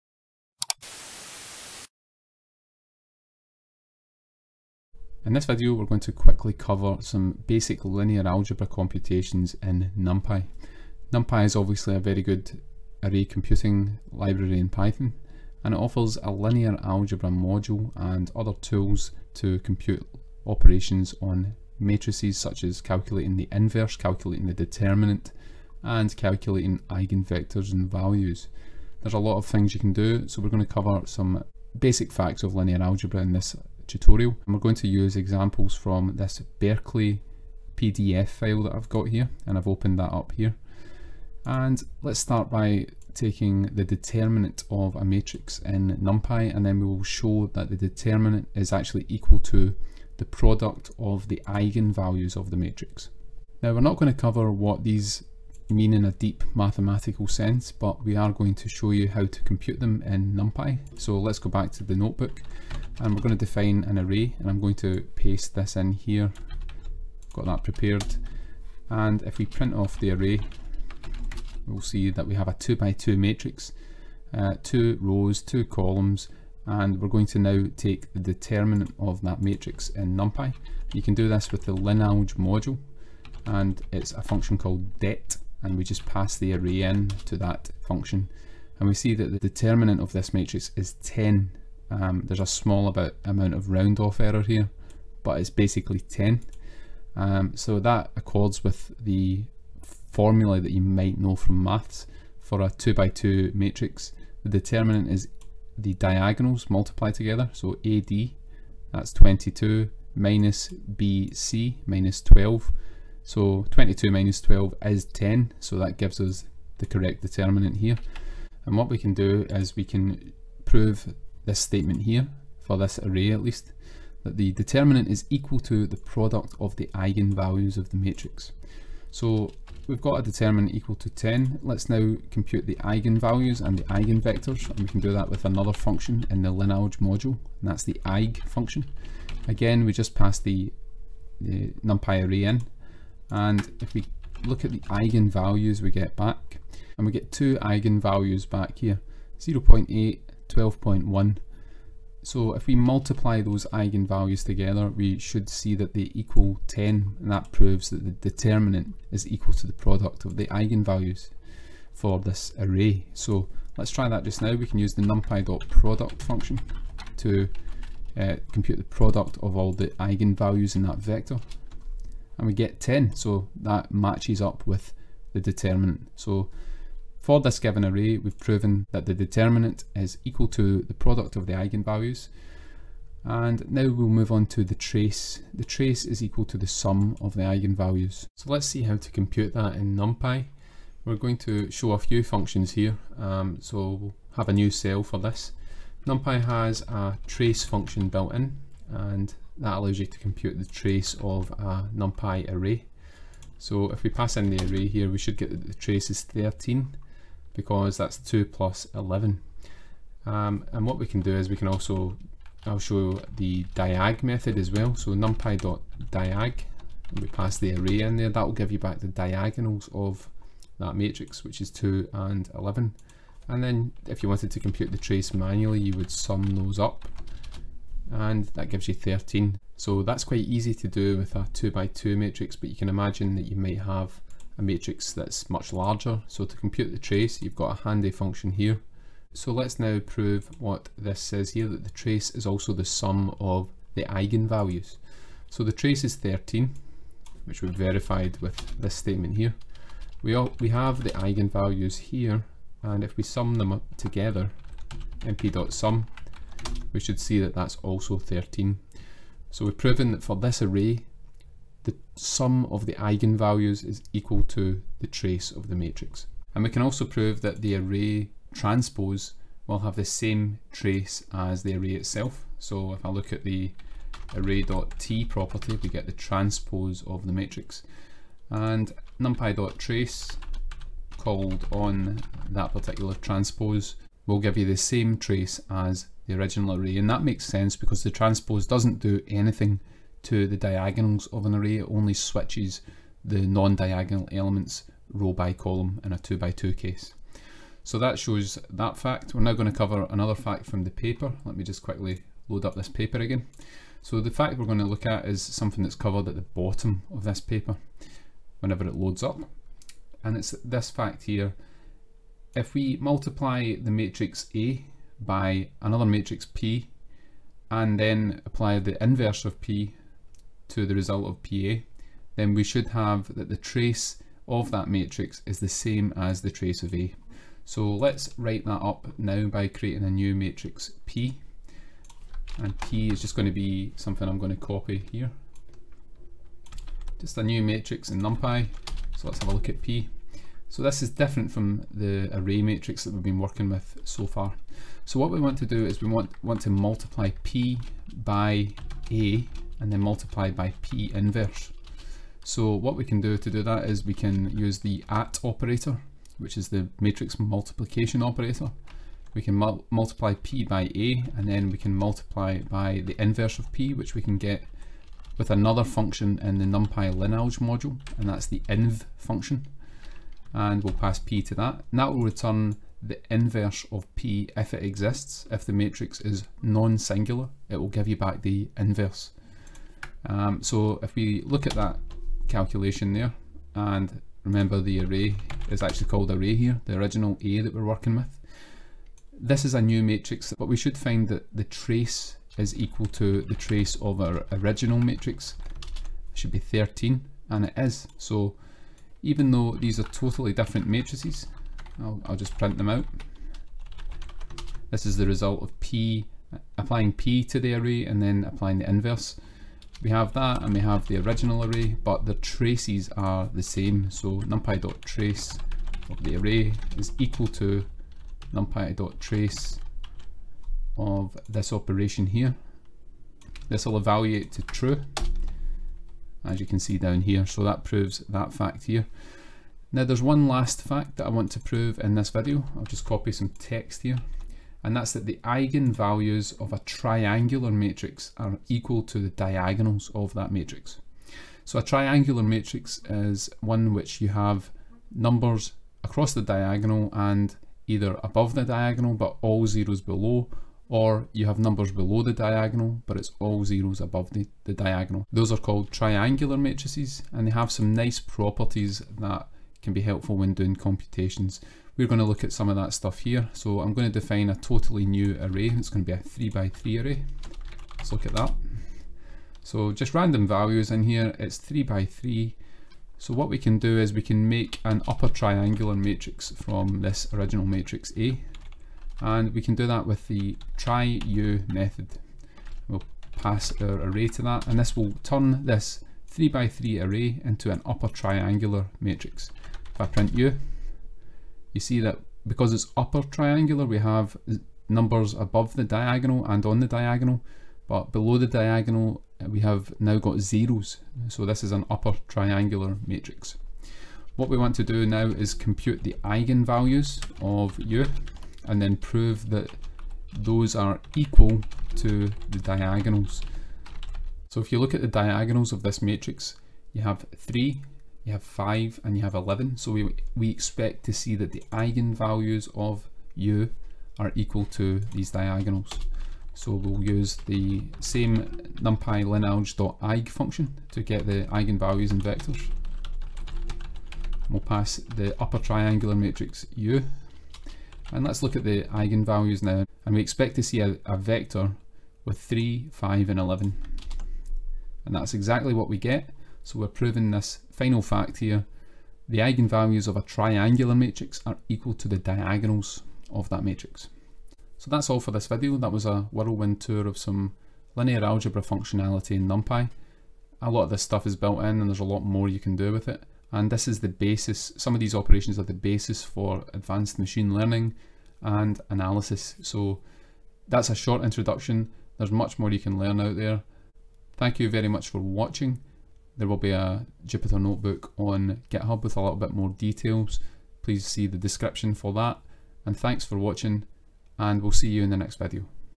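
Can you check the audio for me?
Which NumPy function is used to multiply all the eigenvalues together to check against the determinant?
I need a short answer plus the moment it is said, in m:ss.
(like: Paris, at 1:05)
numpy.product, at 2:45.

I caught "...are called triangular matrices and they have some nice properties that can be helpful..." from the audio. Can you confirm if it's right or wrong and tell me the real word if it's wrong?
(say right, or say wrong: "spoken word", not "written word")
right.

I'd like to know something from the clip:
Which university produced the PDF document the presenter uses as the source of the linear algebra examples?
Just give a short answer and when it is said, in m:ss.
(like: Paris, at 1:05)
Berkeley, at 0:36.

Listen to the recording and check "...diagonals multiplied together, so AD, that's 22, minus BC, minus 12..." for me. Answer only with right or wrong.
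right.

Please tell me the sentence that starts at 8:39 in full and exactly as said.
So we, we expect to see that the eigenvalues of u are equal to these diagonals.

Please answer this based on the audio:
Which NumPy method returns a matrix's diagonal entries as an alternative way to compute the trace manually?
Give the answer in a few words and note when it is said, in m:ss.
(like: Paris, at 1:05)
numpy.diag, at 3:35.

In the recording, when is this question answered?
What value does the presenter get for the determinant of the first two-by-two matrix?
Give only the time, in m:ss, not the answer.
1:29.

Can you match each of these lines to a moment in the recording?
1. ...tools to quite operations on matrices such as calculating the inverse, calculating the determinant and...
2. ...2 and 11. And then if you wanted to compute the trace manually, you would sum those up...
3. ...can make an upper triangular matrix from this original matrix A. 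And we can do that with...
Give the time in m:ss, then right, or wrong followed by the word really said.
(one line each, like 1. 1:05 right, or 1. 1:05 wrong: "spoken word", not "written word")
1. 0:18 wrong: "compute", not "quite"
2. 3:41 right
3. 7:54 right.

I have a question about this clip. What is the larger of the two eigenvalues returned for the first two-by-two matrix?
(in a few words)
12.1.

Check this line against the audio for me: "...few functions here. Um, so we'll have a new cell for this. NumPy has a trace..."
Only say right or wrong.
right.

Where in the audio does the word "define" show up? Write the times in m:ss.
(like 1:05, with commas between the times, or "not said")
1:03, 7:44.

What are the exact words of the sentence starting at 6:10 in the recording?
And we'll pass P to that.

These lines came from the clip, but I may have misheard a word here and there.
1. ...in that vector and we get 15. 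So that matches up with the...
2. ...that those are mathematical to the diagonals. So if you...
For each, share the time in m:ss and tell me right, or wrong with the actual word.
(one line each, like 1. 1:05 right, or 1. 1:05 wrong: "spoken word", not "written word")
1. 2:50 wrong: "10", not "15"
2. 8:29 wrong: "equal", not "mathematical".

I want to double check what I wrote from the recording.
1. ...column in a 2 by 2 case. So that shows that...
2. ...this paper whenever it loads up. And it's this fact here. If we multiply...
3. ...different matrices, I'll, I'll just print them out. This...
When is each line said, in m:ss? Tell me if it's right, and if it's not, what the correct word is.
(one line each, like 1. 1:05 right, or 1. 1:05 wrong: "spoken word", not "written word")
1. 4:55 right
2. 5:07 right
3. 6:40 right.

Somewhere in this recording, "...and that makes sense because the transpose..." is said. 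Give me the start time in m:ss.
4:46.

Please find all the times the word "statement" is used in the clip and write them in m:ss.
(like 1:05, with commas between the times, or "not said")
2:01, 4:08.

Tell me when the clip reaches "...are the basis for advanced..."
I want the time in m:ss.
9:25.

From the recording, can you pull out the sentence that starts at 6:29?
This is a new matrix, but we should find that the trace is equal to the trace of our original matrix.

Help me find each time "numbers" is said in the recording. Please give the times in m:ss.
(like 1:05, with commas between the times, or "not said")
7:25, 7:31, 8:14.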